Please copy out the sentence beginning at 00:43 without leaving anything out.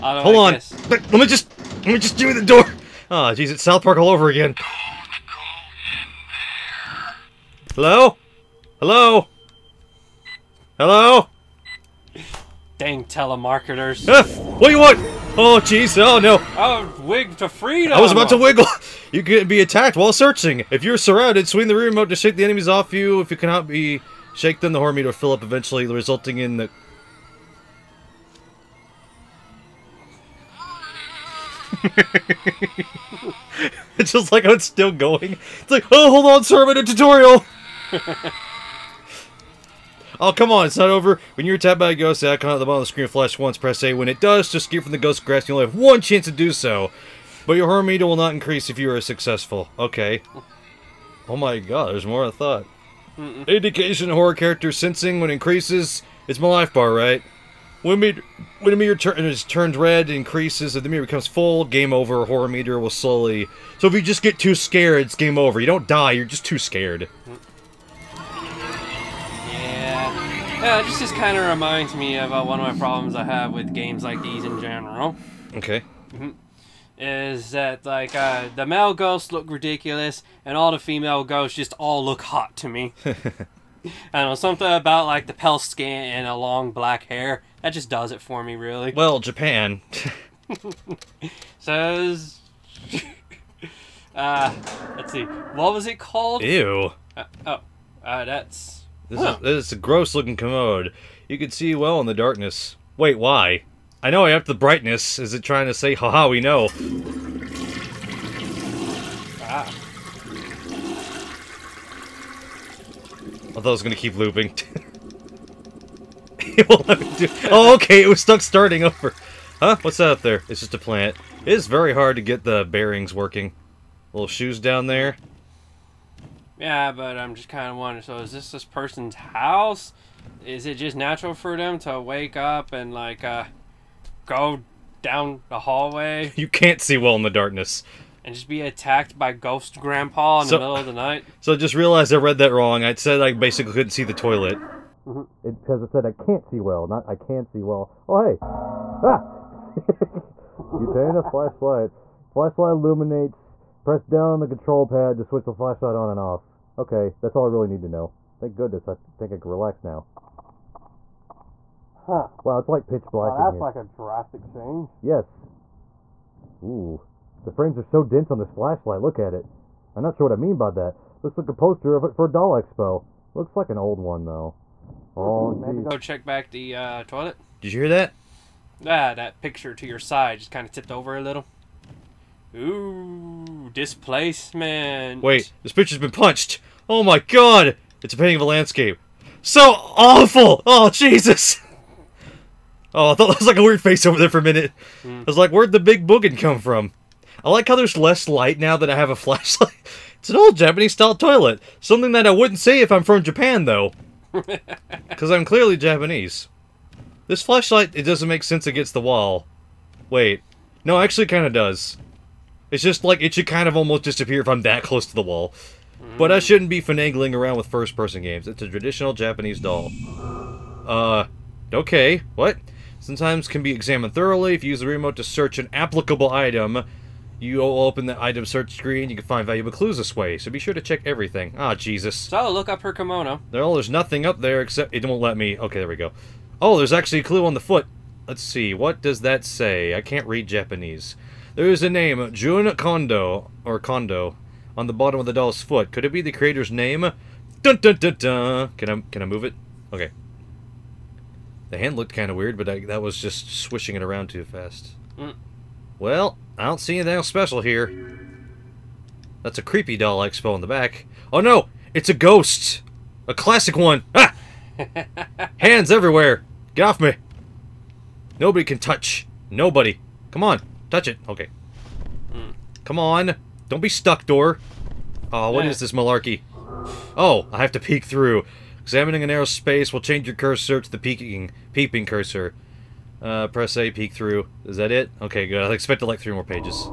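When it does, just escape from the ghost grass.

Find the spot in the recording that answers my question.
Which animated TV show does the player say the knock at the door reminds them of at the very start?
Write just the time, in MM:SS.
00:03.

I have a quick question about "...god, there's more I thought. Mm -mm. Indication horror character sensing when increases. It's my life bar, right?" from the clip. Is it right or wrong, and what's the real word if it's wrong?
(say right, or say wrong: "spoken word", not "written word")
right.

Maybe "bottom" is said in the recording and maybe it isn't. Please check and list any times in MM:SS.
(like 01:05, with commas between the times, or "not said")
00:42, 04:04.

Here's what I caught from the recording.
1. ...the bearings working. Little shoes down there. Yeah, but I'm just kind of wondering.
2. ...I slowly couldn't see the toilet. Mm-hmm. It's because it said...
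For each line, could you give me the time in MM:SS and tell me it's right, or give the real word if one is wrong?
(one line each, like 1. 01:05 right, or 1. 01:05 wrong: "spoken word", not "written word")
1. 02:02 right
2. 02:23 wrong: "basically", not "slowly".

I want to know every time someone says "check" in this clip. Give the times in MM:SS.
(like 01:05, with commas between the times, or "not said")
02:55, 03:50.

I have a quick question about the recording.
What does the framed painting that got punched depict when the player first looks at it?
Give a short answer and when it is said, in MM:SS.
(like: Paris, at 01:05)
a landscape, at 03:08.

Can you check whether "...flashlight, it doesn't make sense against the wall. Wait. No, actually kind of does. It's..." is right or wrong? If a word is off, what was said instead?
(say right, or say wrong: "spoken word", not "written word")
right.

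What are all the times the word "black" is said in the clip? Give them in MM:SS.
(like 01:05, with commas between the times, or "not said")
01:26, 02:43.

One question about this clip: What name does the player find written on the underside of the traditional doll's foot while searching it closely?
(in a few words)
Jun Kondo.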